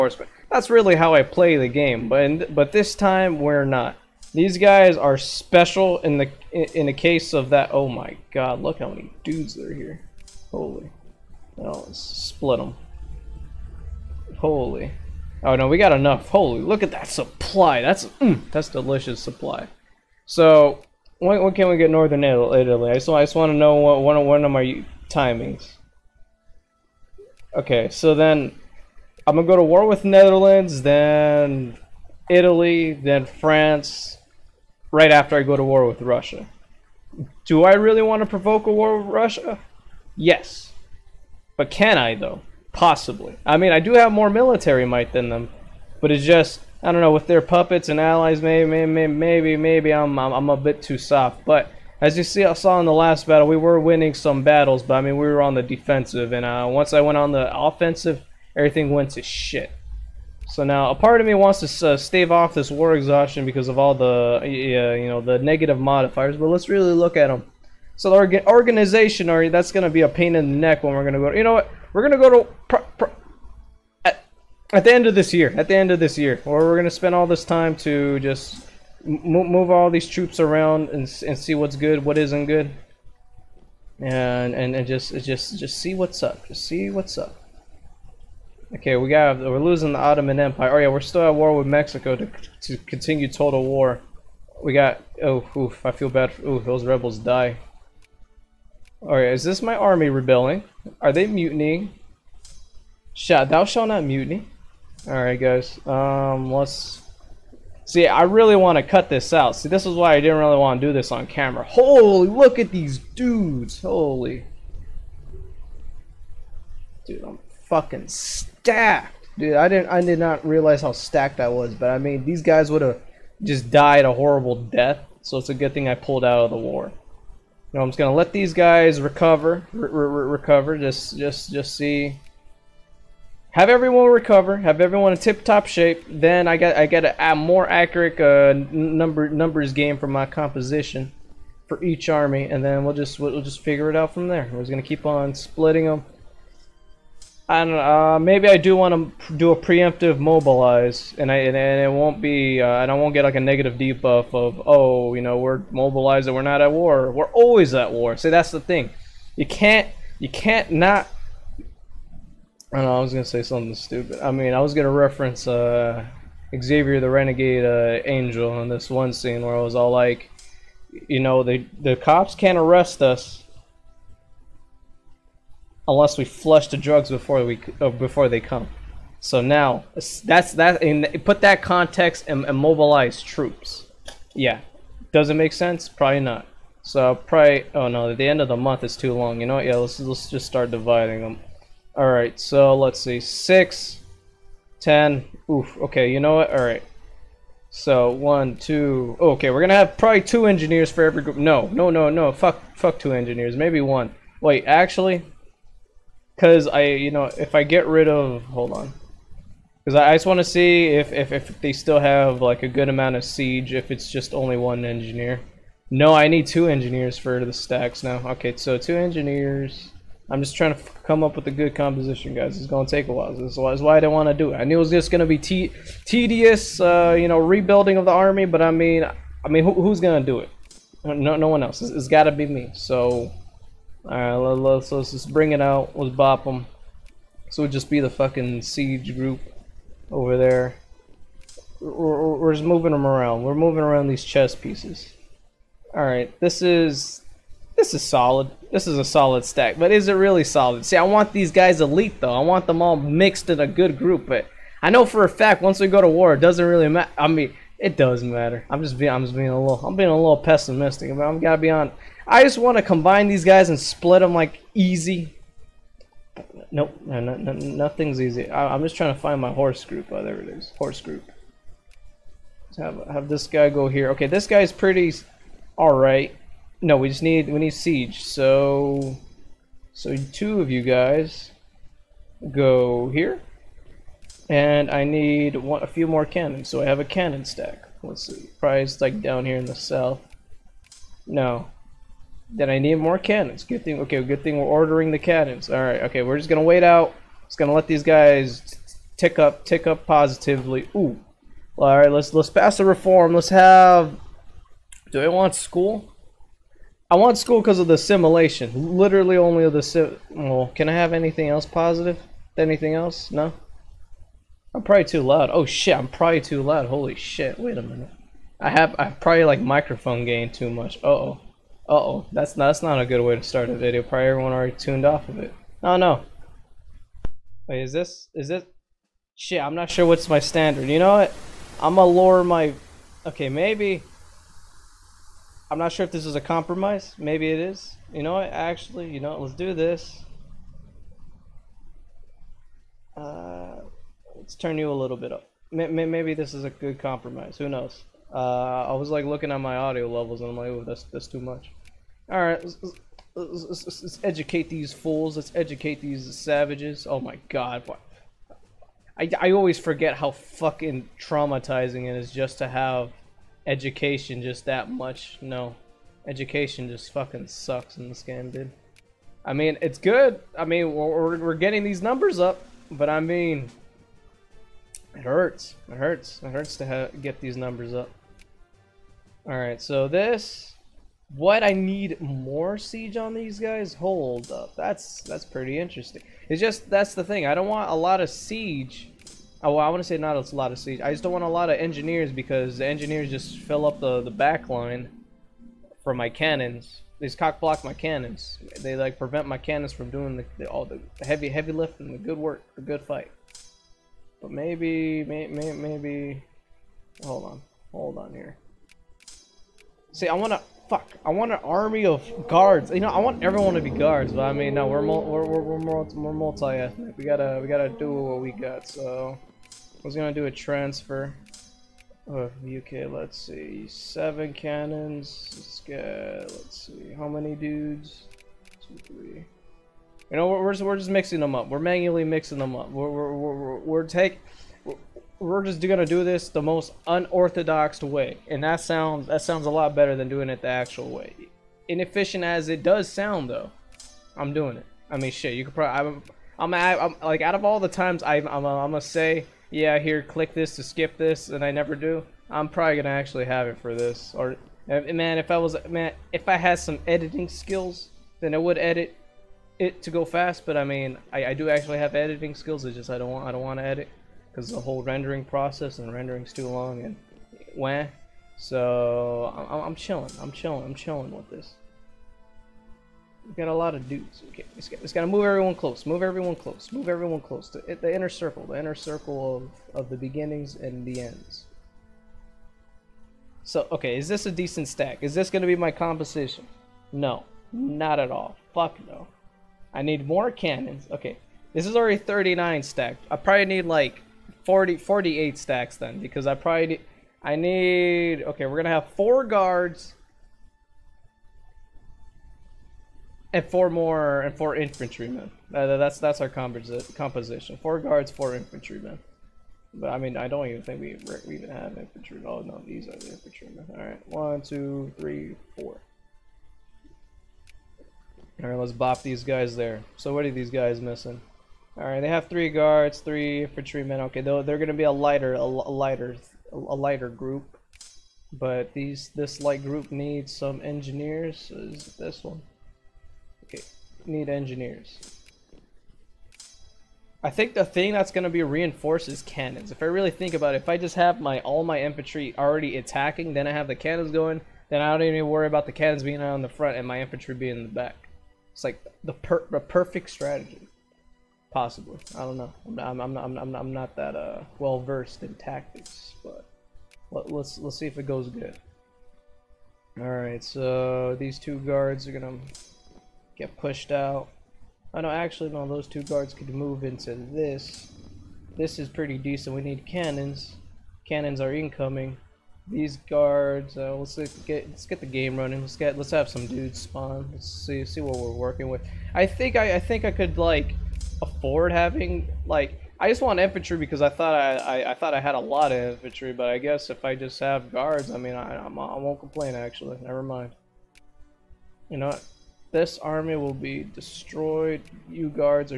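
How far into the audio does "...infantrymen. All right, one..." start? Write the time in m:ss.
8:33.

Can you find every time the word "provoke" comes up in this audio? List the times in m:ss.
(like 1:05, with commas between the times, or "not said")
0:38.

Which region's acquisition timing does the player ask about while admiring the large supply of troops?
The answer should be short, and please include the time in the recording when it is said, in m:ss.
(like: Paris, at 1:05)
Northern Italy, at 0:21.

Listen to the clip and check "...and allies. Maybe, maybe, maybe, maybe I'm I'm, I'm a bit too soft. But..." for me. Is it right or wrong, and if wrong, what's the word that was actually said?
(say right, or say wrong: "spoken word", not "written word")
right.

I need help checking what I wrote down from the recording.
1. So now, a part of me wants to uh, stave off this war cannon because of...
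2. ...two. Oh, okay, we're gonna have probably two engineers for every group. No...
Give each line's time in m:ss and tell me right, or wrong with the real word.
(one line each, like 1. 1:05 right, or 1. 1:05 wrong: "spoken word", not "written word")
1. 1:00 wrong: "exhaustion", not "cannon"
2. 3:18 right.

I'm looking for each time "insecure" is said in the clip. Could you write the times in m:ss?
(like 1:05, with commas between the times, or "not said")
not said.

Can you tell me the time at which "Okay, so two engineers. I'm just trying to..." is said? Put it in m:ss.
3:38.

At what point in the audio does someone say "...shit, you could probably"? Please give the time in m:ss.
7:25.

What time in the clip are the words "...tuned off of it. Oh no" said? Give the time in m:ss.
5:24.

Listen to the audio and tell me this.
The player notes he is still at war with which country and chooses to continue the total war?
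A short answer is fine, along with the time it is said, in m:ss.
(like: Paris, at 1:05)
Mexico, at 1:31.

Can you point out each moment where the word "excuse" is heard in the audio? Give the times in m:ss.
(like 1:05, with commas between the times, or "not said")
not said.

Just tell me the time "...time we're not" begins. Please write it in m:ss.
0:02.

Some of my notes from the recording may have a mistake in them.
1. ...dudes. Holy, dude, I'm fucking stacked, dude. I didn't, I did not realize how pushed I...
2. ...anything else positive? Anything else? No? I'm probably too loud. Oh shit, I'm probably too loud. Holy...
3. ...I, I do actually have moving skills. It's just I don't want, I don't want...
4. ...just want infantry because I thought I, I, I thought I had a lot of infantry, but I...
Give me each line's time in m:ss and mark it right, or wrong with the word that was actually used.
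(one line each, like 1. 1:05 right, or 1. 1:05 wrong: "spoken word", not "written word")
1. 1:52 wrong: "stacked", not "pushed"
2. 5:11 right
3. 7:41 wrong: "editing", not "moving"
4. 9:43 right.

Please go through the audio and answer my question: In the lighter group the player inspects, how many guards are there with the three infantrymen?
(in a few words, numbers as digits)
3.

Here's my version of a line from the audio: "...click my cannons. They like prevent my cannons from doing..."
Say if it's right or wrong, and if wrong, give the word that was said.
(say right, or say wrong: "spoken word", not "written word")
wrong: "block", not "click".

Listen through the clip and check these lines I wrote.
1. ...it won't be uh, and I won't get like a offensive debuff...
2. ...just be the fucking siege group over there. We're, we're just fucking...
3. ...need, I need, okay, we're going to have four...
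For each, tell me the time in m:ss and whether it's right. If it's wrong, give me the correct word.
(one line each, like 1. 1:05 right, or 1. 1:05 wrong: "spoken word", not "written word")
1. 2:31 wrong: "negative", not "offensive"
2. 3:57 wrong: "moving", not "fucking"
3. 8:16 right.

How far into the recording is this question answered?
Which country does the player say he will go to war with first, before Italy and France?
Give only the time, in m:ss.
0:30.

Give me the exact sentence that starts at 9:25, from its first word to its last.
actually no, those two guards could move into this.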